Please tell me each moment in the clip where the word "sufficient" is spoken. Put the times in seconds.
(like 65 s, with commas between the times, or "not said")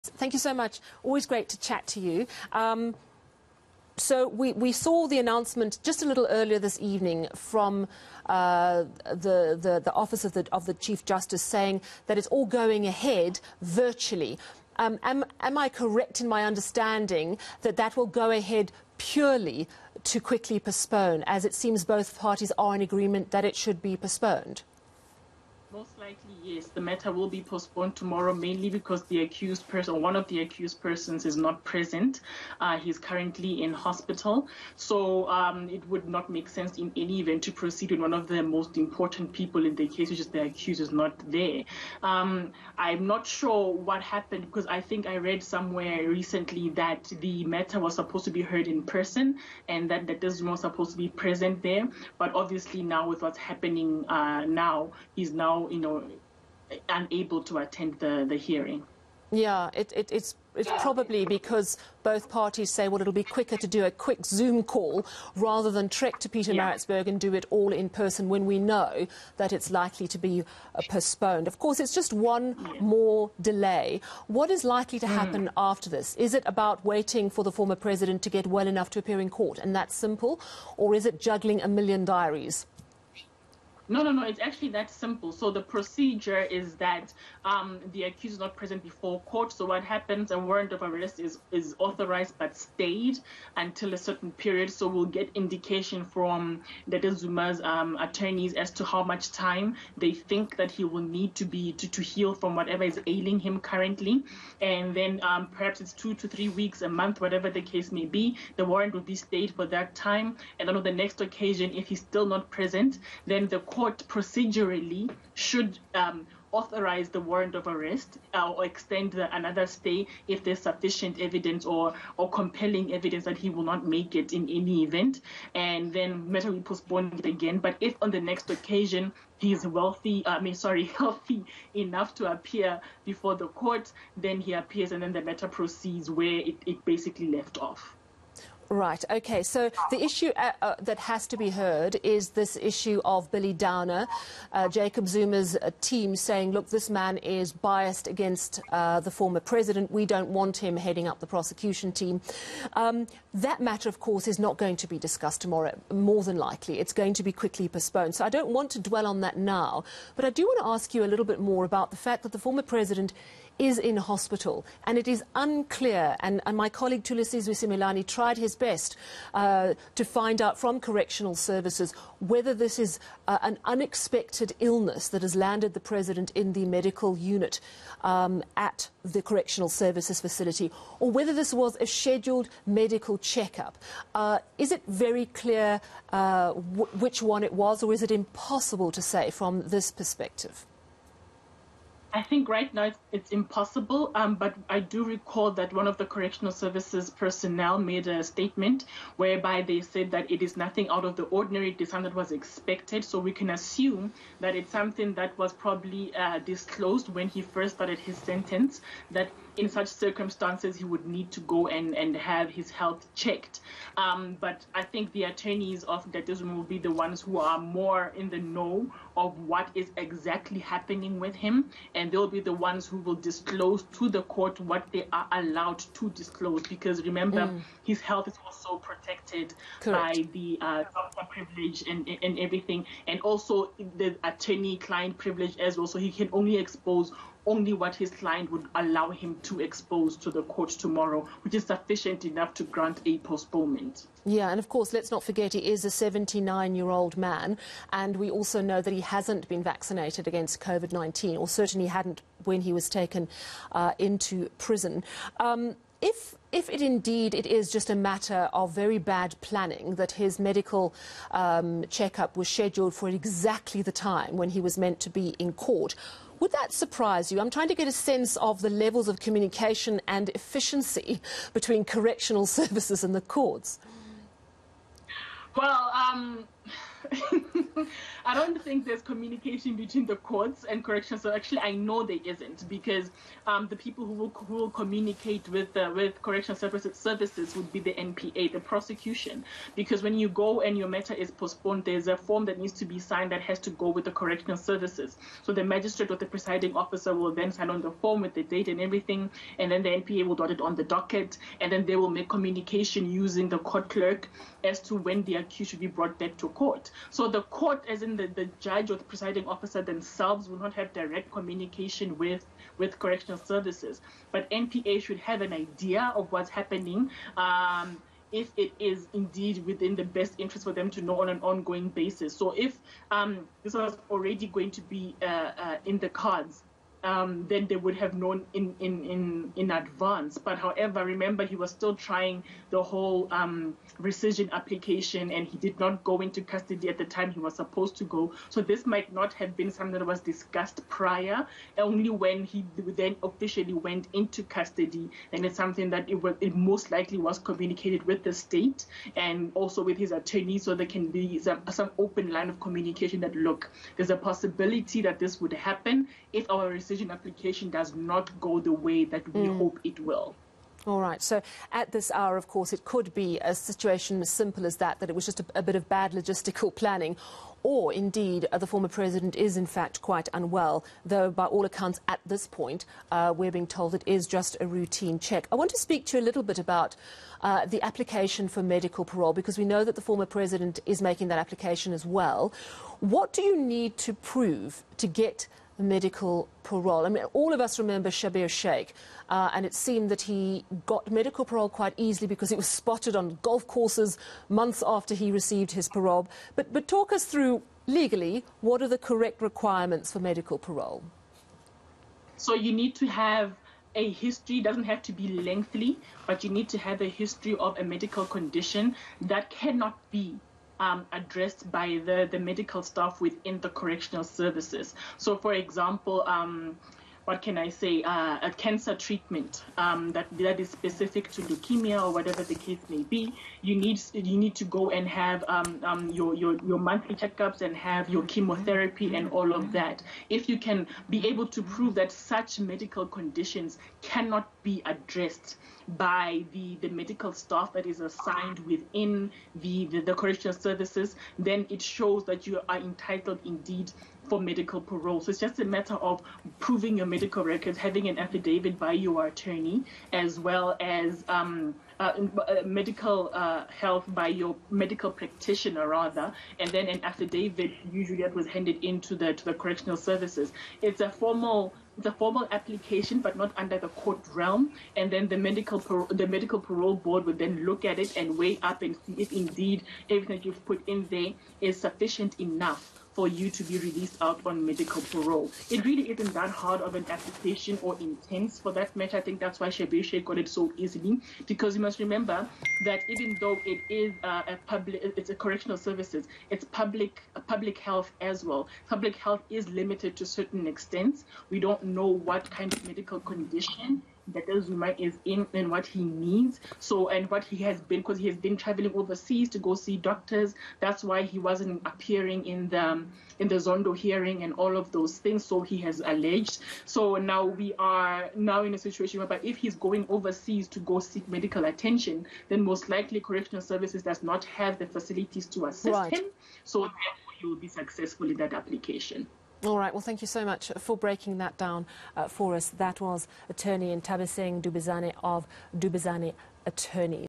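120 s, 241 s, 471 s.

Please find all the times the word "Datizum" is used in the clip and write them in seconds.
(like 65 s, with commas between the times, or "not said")
216 s.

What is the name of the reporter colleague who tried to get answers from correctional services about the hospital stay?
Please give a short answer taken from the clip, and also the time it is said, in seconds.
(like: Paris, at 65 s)
Thulasizwe Simelane, at 167 s.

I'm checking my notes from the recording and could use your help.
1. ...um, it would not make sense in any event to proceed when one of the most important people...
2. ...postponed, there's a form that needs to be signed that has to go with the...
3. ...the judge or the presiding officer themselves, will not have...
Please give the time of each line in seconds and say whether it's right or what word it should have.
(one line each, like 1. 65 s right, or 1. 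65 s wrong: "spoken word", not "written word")
1. 35 s right
2. 291 s right
3. 308 s right.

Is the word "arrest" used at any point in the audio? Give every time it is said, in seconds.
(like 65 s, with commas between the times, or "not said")
90 s, 117 s.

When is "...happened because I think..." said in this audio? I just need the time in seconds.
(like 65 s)
44 s.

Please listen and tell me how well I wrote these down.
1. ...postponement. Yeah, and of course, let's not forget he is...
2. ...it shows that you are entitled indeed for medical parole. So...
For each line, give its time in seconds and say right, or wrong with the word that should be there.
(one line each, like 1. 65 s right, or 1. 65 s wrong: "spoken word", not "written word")
1. 243 s right
2. 441 s right.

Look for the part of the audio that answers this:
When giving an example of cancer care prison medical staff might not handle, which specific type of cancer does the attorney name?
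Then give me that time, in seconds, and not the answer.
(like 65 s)
421 s.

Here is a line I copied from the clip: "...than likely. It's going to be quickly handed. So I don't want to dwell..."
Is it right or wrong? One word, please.
wrong.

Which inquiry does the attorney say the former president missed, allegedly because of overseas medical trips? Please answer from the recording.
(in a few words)
Zondo hearing.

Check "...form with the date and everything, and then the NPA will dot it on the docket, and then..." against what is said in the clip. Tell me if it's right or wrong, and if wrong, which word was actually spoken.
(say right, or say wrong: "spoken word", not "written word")
right.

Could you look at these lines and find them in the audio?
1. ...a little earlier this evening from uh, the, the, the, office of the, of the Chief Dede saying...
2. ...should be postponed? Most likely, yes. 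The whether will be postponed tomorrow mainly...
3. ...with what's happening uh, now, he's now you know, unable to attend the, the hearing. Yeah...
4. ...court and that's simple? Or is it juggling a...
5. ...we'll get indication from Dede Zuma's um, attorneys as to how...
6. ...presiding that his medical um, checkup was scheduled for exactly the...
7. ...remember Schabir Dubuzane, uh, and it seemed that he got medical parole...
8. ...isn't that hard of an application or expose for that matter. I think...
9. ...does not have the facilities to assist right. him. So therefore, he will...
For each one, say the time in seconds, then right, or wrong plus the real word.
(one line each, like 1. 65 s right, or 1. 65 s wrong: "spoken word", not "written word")
1. 6 s wrong: "Justice", not "Dede"
2. 23 s wrong: "matter", not "whether"
3. 53 s right
4. 79 s right
5. 94 s right
6. 259 s wrong: "planning", not "presiding"
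7. 387 s wrong: "Shaik", not "Dubuzane"
8. 476 s wrong: "intense", not "expose"
9. 514 s right.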